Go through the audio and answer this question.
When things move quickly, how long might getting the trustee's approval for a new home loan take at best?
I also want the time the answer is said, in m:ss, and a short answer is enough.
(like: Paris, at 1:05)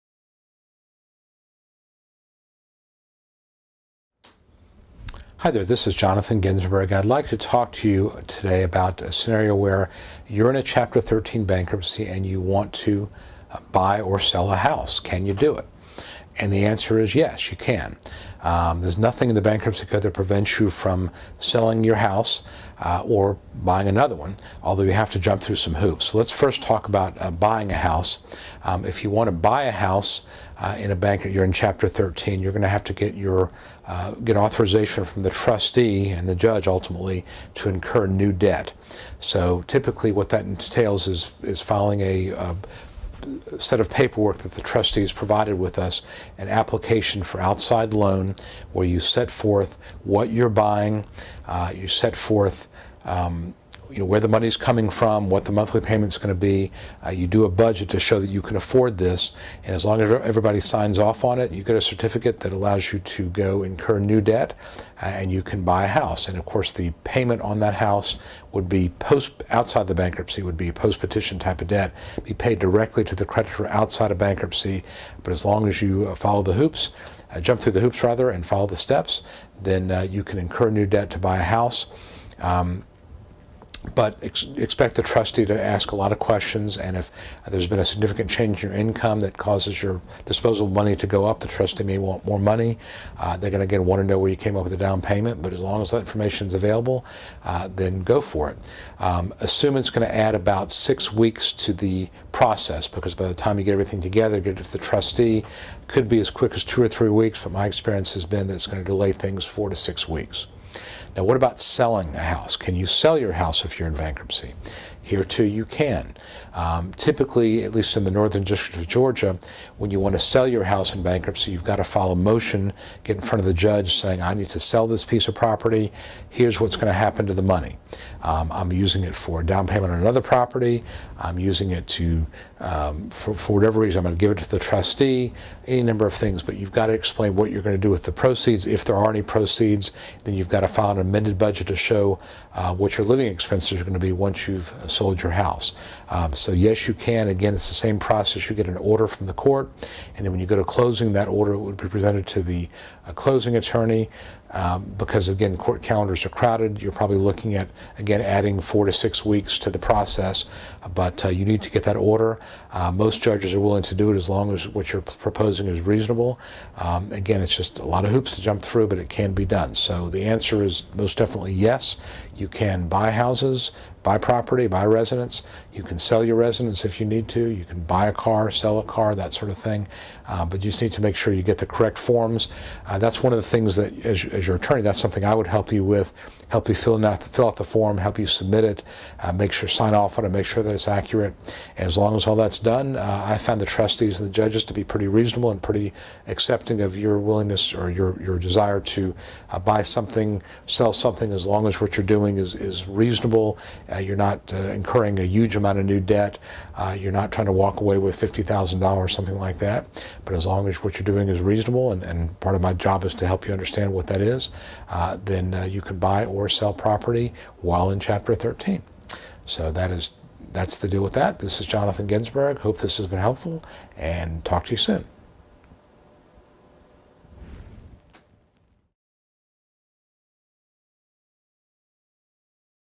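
2 or 3 weeks, at 1:46.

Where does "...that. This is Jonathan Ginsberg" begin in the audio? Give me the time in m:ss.
3:41.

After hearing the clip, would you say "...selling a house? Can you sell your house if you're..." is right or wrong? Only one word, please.
right.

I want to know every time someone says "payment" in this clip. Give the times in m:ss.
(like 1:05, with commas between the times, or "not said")
0:55, 1:07, 1:35, 2:09.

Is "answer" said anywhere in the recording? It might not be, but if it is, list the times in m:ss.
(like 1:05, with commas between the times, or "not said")
0:16, 2:50.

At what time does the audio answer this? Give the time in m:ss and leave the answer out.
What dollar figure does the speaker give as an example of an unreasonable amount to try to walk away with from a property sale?
3:28.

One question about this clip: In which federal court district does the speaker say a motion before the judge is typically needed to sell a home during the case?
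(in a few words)
Northern District of Georgia.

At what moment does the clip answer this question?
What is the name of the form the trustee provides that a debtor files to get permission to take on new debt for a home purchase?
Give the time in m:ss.
0:46.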